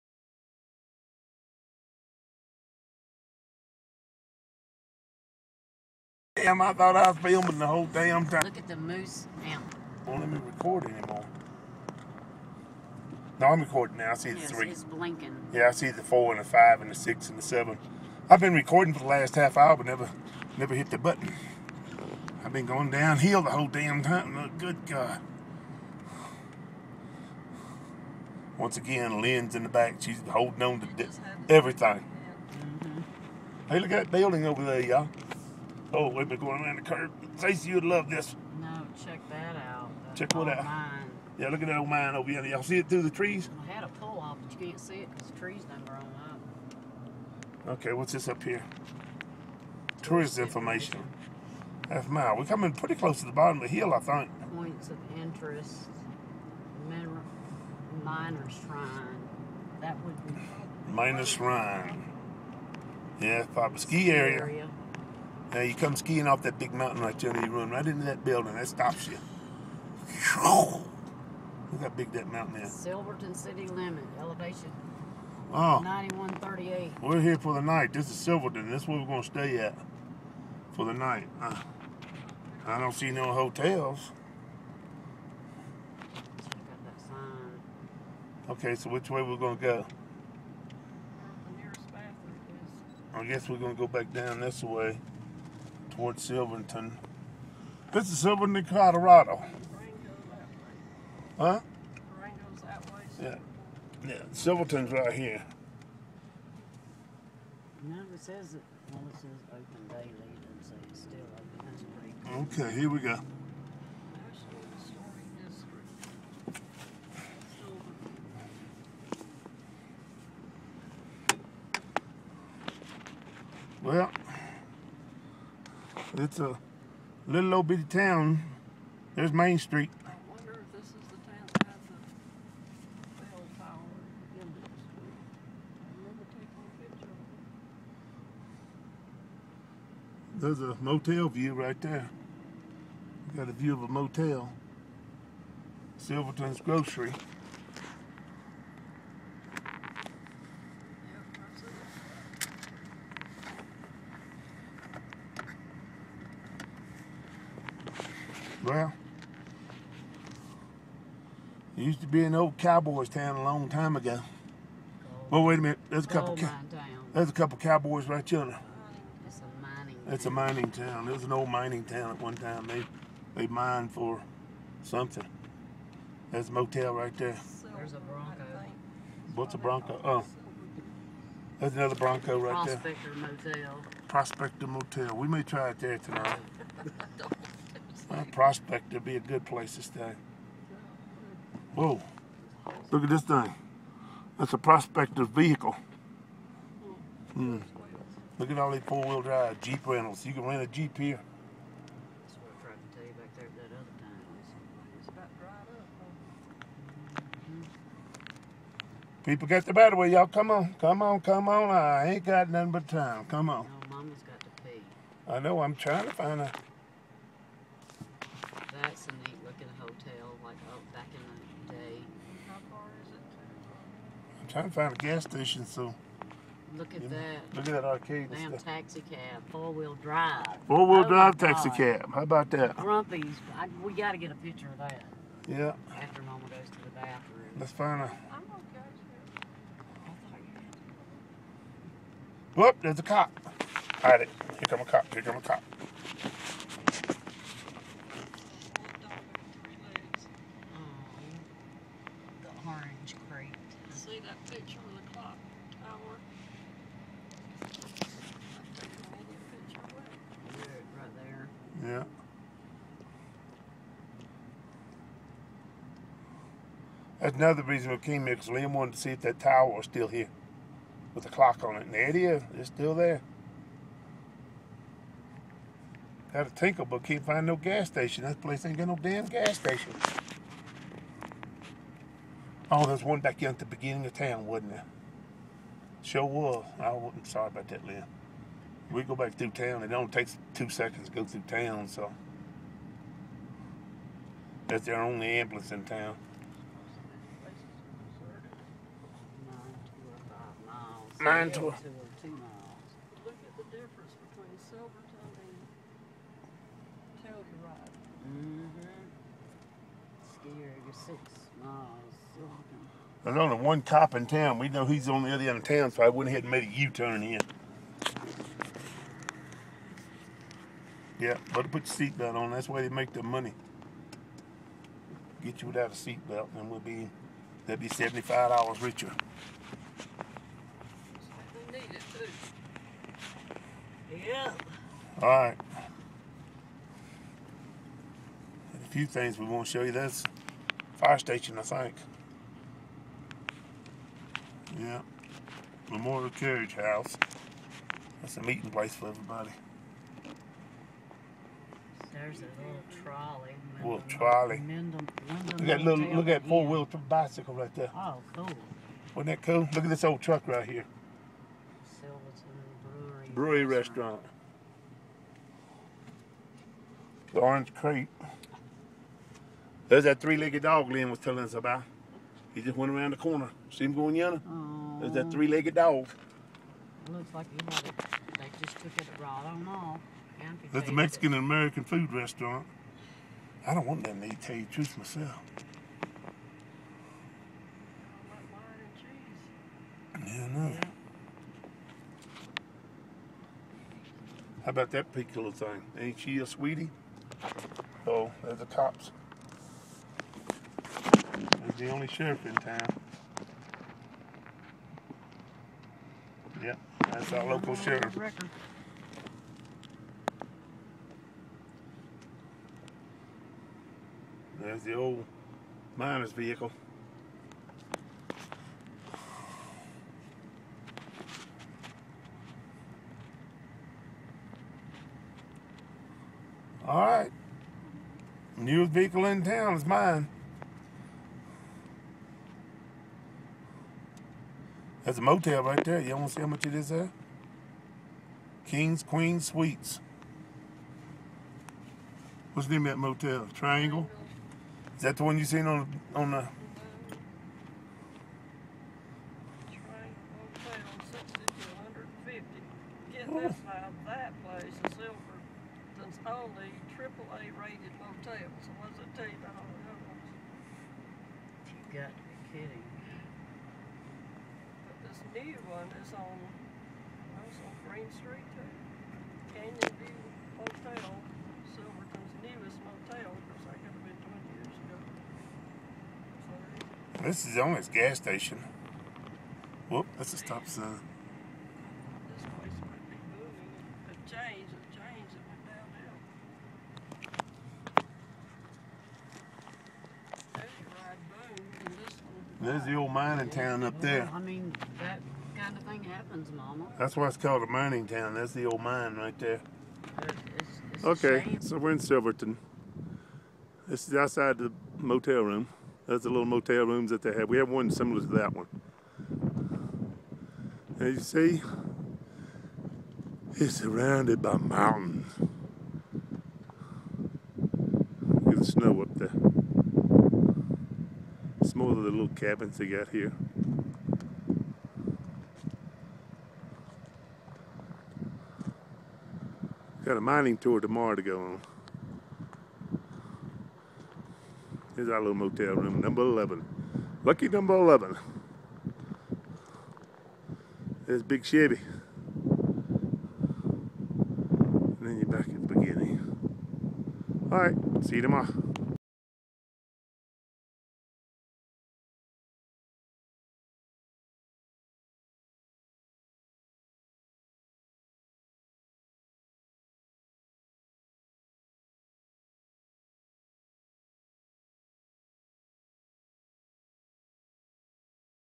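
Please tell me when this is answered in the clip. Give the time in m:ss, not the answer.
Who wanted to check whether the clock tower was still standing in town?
4:28.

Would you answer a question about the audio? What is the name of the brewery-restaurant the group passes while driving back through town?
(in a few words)
Silverton Brewery.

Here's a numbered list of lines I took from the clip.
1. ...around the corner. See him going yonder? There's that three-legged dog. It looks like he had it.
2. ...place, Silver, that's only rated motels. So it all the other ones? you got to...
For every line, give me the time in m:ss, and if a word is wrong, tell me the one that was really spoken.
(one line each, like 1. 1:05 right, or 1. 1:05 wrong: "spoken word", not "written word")
1. 6:12 right
2. 7:34 right.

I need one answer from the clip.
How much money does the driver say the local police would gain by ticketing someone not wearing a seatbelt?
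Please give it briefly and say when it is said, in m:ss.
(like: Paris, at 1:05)
$75, at 5:27.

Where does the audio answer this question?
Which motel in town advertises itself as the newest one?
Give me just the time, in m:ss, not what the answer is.
7:49.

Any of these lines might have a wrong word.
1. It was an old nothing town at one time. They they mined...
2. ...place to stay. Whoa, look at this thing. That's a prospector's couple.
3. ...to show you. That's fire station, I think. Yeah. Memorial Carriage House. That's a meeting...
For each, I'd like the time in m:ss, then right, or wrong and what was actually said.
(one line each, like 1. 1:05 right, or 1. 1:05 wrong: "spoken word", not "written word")
1. 2:51 wrong: "mining", not "nothing"
2. 3:09 wrong: "vehicle", not "couple"
3. 5:39 right.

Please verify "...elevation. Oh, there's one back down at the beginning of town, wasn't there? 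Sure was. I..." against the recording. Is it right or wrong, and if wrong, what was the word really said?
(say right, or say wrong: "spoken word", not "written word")
wrong: "station", not "elevation".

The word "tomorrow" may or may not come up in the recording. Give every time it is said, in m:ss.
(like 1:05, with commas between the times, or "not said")
8:50, 9:08.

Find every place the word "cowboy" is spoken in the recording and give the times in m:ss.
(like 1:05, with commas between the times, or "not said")
2:42, 2:47.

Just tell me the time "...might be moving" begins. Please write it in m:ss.
8:02.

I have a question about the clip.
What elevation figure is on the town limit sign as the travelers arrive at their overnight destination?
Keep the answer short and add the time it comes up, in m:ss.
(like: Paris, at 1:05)
9138, at 1:15.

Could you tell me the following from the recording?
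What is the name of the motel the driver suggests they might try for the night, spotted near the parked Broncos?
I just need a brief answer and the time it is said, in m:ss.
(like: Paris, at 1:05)
Prospector Motel, at 3:04.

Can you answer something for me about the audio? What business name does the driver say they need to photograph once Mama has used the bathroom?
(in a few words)
Grumpy's.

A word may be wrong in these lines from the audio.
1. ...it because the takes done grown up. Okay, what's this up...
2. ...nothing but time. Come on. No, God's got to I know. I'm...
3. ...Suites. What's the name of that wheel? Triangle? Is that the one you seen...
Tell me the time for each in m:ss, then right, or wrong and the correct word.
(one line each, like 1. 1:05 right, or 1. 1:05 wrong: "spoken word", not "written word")
1. 0:44 wrong: "trees", not "takes"
2. 3:32 wrong: "Mama", not "God"
3. 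7:19 wrong: "motel", not "wheel".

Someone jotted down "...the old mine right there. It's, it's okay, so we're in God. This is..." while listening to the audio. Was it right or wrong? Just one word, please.
wrong.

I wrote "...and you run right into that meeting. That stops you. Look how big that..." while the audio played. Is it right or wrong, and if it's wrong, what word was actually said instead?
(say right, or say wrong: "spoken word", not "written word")
wrong: "building", not "meeting".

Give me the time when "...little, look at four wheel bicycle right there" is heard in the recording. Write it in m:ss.
5:55.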